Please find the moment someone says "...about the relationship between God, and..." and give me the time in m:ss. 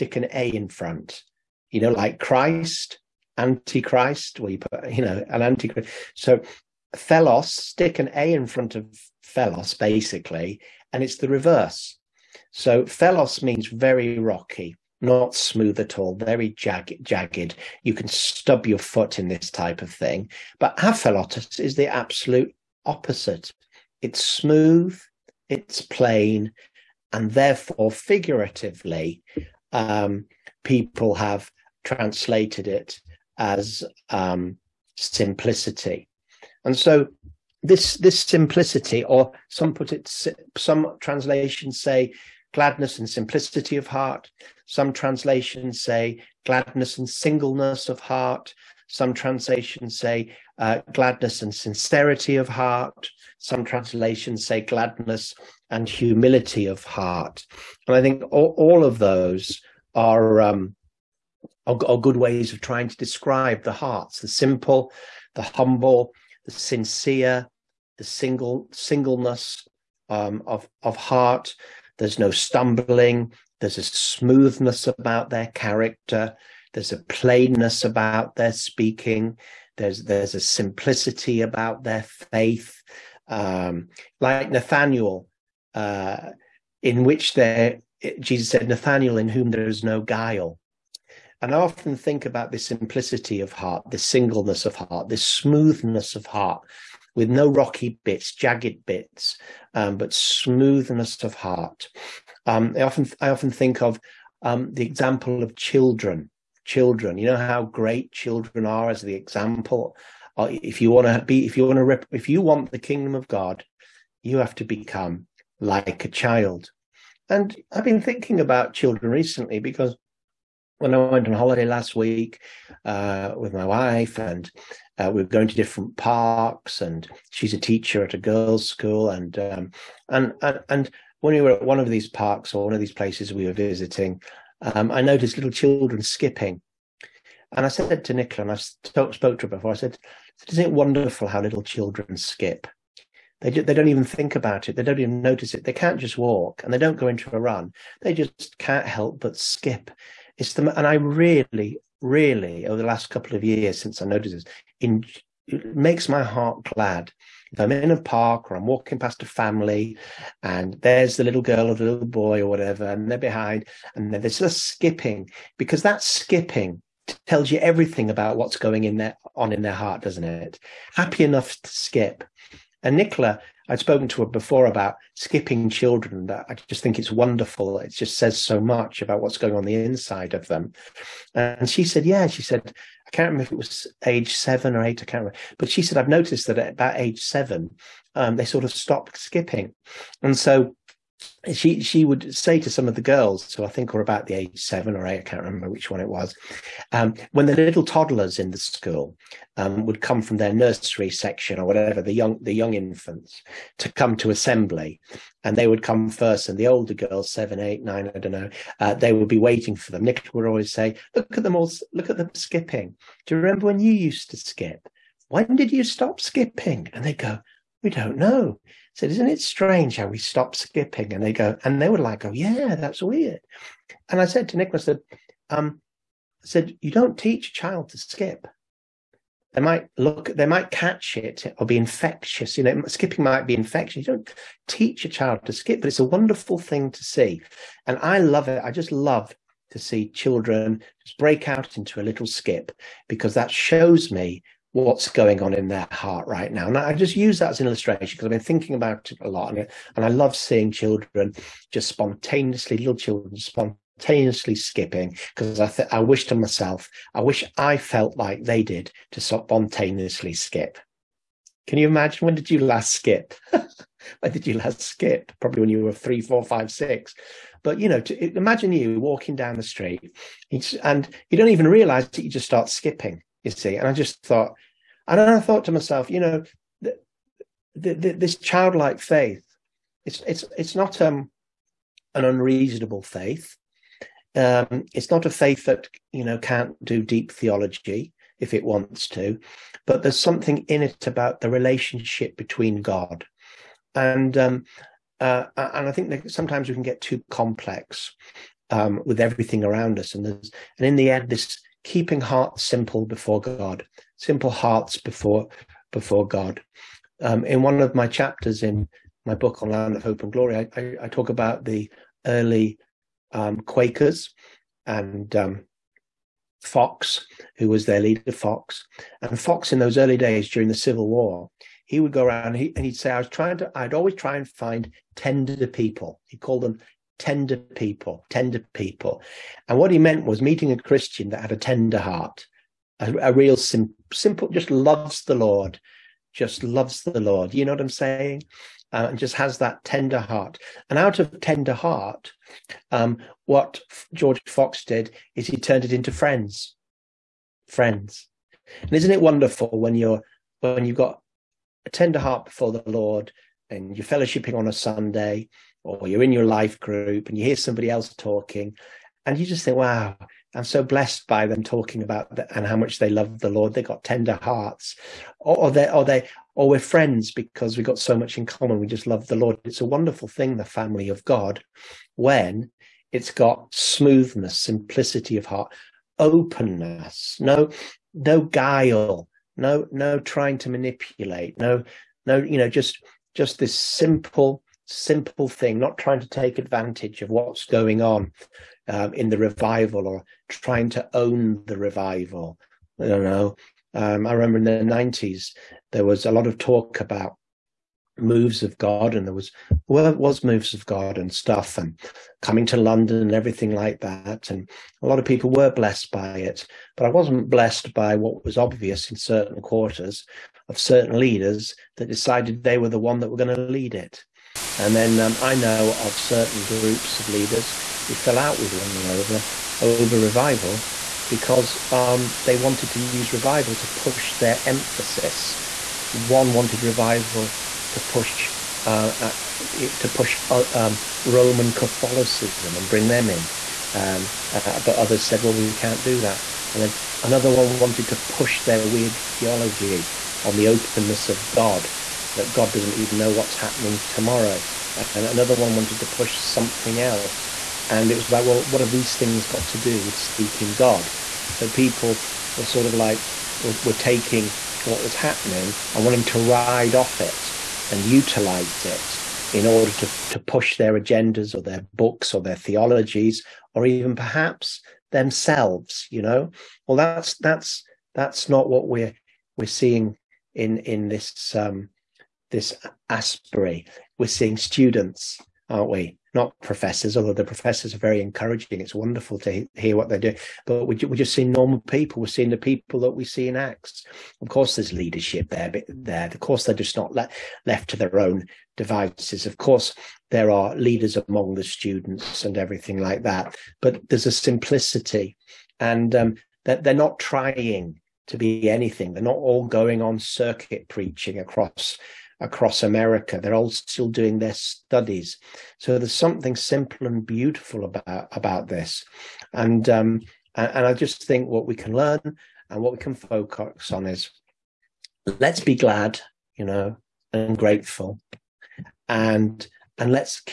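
4:51.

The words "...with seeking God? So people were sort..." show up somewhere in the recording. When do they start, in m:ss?
7:30.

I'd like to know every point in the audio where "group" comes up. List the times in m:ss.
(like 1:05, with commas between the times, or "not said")
5:56, 6:56.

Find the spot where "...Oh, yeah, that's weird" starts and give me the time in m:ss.
3:42.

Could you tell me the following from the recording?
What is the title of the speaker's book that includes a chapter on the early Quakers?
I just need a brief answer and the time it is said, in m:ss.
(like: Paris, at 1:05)
Land of Hope and Glory, at 5:09.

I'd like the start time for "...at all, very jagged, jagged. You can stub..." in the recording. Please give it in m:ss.
0:15.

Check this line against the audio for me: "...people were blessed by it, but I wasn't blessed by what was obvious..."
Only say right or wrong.
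right.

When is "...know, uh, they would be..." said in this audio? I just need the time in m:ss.
3:28.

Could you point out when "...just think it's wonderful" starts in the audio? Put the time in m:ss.
2:56.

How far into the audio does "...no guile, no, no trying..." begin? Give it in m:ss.
6:18.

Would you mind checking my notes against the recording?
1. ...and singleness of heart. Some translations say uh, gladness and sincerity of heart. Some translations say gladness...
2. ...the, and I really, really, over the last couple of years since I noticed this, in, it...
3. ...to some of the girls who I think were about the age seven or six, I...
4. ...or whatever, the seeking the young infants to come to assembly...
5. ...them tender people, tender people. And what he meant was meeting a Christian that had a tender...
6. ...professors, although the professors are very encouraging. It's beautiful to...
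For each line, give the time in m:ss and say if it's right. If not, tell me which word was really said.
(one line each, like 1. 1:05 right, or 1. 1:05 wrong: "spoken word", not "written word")
1. 0:46 right
2. 2:30 right
3. 3:12 wrong: "eight", not "six"
4. 3:21 wrong: "young", not "seeking"
5. 5:26 right
6. 7:56 wrong: "wonderful", not "beautiful".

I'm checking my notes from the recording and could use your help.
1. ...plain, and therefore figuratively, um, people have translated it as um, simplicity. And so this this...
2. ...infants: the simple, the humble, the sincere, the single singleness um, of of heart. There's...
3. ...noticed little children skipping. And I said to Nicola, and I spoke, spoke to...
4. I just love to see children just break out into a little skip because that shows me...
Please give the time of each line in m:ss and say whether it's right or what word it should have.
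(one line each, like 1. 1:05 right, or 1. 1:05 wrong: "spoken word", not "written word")
1. 0:25 right
2. 1:03 wrong: "hearts", not "infants"
3. 2:15 right
4. 3:58 right.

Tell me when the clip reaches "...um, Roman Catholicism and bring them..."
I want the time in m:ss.
7:10.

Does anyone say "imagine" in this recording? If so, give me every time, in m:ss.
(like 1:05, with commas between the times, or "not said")
4:21, 4:28.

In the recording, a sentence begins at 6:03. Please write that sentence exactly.
They got tender hearts, or, or they, or they, or we're friends because we have got so much in common.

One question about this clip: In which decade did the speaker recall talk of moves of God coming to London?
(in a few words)
the 90s.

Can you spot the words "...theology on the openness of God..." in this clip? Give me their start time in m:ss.
7:19.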